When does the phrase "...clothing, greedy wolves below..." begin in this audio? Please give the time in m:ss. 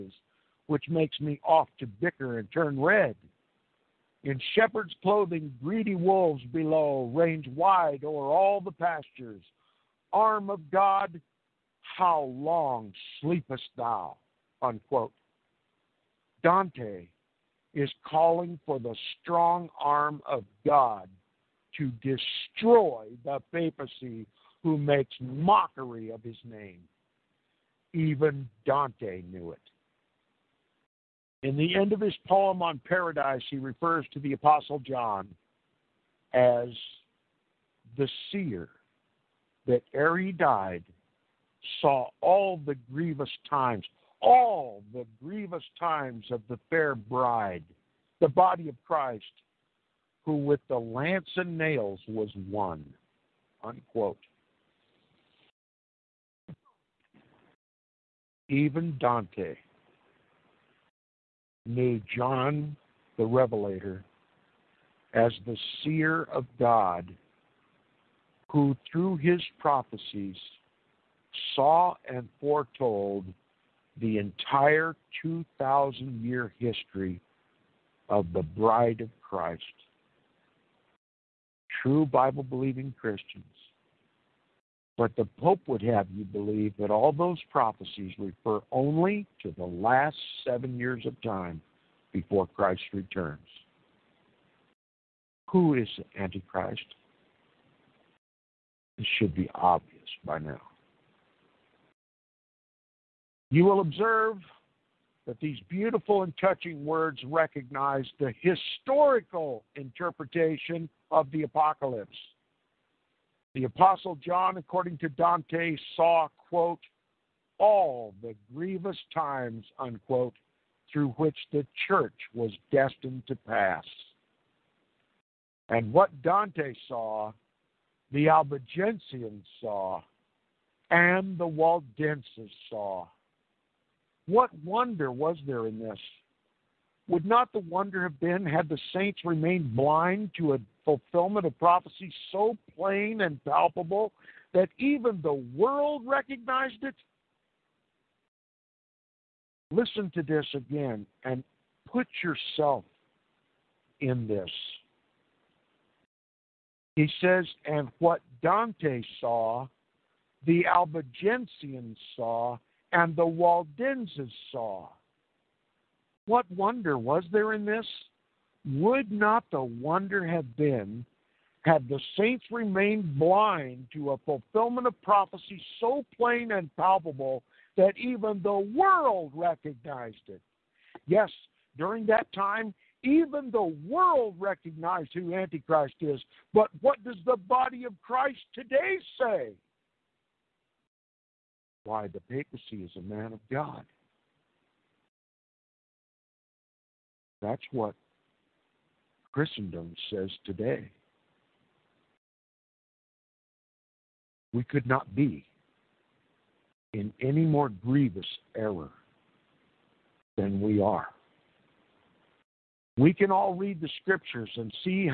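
0:05.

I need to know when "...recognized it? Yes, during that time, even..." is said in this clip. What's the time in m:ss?
2:59.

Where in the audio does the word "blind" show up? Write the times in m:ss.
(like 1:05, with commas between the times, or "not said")
2:19, 2:53.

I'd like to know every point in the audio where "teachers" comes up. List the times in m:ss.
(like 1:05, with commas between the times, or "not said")
not said.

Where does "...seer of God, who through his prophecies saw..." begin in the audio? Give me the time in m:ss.
1:05.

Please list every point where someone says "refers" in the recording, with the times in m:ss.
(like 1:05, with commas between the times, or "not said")
0:33, 1:28.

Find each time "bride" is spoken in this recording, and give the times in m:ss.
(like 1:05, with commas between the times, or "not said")
0:46, 1:18.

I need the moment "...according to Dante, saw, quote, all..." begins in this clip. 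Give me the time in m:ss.
1:54.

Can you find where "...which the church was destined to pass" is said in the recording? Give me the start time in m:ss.
2:01.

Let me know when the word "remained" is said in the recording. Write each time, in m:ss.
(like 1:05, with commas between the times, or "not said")
2:19, 2:52.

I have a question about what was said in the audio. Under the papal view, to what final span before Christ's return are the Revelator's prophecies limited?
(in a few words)
7 years.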